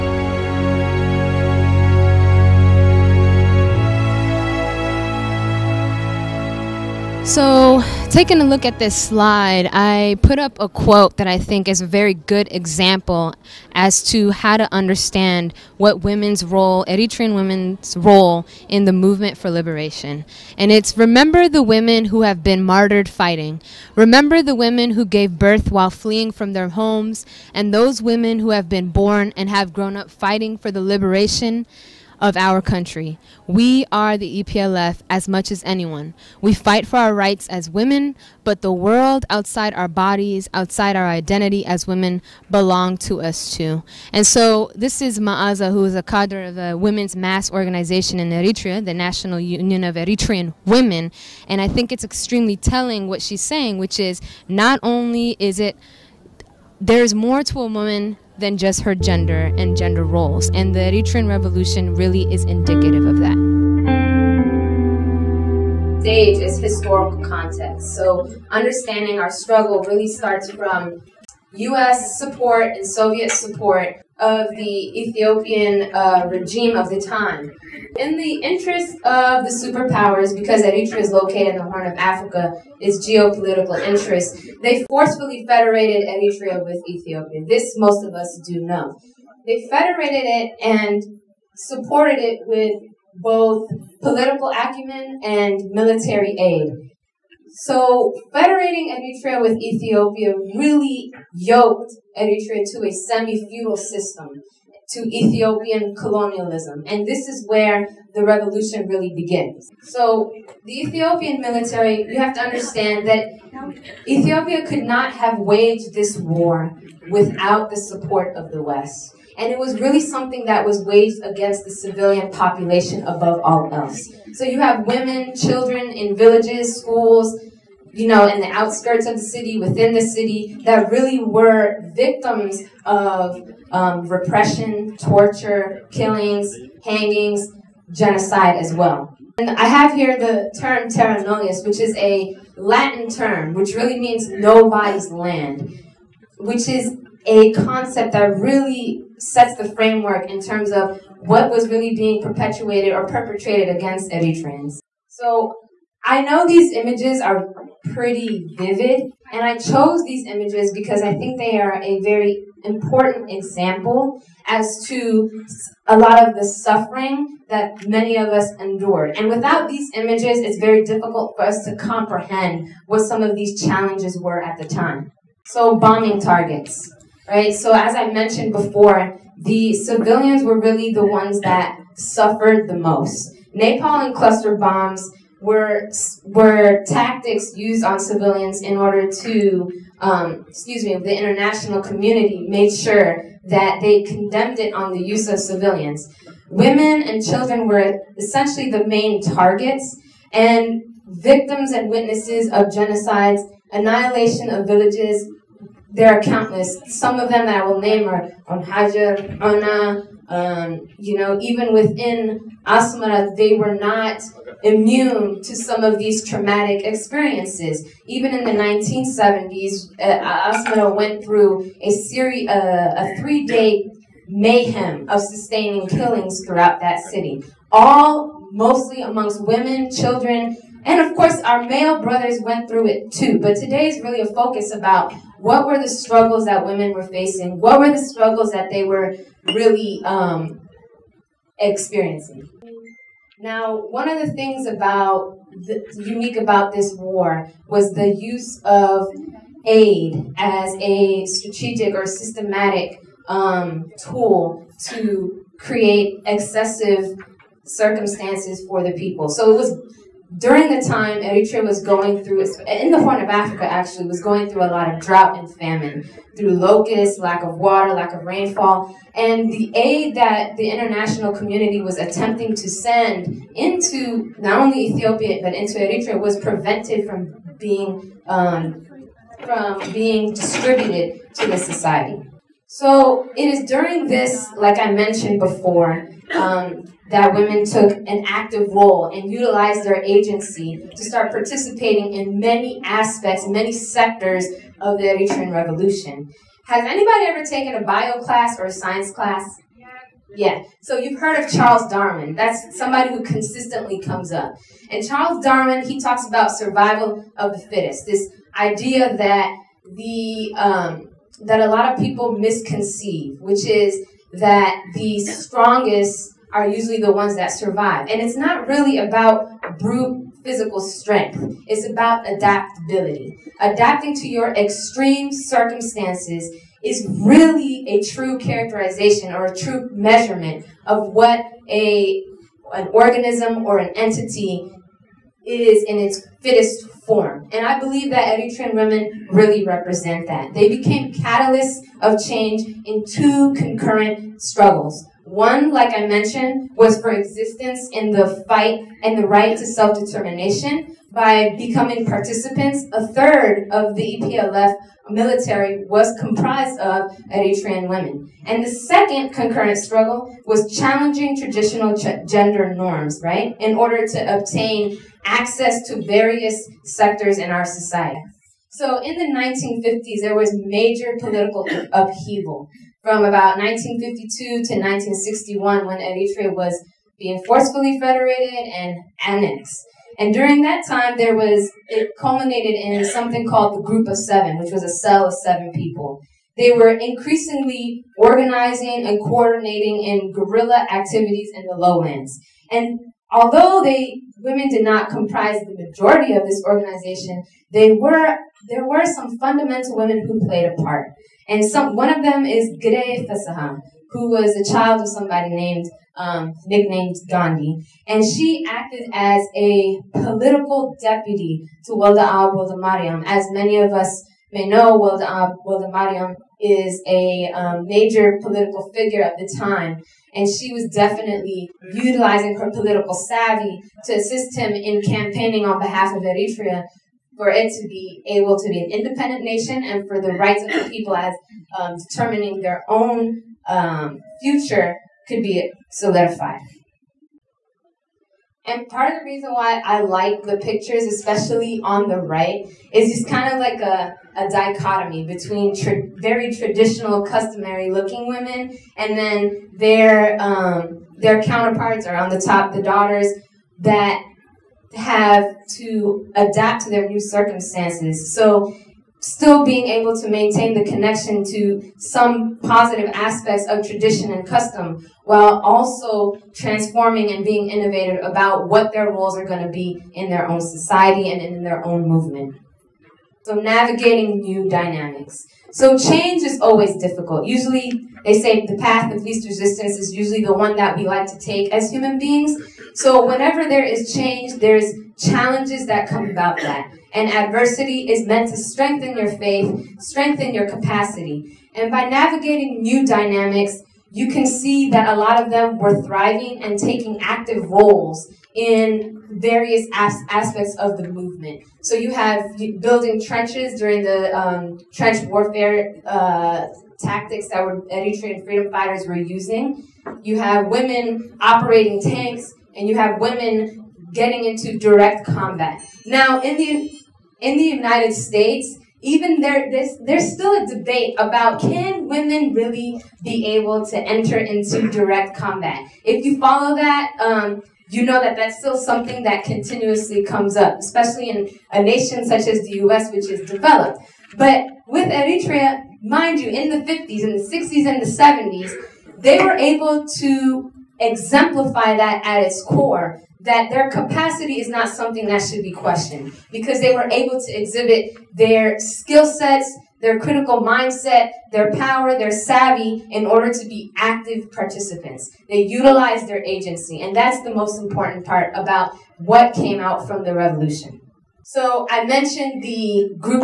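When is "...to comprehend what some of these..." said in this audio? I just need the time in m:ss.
2:51.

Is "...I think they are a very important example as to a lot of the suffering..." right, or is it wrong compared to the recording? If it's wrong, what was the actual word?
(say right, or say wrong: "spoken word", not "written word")
right.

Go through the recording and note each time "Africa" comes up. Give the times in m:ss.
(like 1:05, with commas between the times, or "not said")
1:21, 4:23.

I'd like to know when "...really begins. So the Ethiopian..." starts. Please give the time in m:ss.
1:48.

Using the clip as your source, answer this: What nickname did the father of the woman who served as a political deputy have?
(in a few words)
Gandhi.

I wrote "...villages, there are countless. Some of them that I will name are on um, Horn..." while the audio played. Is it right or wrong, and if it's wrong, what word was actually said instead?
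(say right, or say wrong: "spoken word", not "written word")
wrong: "Hajar", not "Horn".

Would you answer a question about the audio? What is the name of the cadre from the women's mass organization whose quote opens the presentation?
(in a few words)
Maaza.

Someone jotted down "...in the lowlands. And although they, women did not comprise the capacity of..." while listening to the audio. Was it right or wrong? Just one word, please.
wrong.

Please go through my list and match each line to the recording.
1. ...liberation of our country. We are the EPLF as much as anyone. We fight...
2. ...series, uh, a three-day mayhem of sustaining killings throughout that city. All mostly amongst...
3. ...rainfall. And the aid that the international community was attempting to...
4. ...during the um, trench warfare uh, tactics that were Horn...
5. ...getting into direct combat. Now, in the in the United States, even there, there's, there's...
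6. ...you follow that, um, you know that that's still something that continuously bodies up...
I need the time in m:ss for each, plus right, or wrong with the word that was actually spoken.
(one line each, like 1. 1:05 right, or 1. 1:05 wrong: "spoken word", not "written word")
1. 0:30 right
2. 3:41 right
3. 4:28 right
4. 8:23 wrong: "Eritrean", not "Horn"
5. 8:34 right
6. 8:46 wrong: "comes", not "bodies".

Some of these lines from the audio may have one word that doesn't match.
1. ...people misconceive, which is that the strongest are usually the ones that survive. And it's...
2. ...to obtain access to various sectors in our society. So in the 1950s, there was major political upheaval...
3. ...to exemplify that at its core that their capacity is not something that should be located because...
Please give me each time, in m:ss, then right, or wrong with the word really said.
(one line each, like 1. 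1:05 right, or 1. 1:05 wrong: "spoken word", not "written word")
1. 5:11 right
2. 6:04 right
3. 9:00 wrong: "questioned", not "located".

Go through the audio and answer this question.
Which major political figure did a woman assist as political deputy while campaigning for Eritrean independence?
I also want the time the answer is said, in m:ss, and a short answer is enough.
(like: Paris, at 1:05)
Woldeab Woldemariam, at 6:51.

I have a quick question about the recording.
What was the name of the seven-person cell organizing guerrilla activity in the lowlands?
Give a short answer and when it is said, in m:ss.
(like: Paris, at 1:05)
Group of Seven, at 6:23.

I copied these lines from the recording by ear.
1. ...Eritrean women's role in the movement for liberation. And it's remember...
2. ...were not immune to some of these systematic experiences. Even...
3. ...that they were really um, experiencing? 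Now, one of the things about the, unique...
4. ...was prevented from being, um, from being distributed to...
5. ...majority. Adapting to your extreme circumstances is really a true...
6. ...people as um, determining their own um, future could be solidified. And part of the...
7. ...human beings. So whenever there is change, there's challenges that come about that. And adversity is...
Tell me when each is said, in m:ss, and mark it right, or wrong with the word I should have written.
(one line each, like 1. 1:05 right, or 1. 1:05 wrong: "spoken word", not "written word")
1. 0:16 right
2. 3:33 wrong: "traumatic", not "systematic"
3. 3:58 right
4. 4:36 right
5. 5:22 wrong: "adaptability", not "majority"
6. 7:10 right
7. 8:01 right.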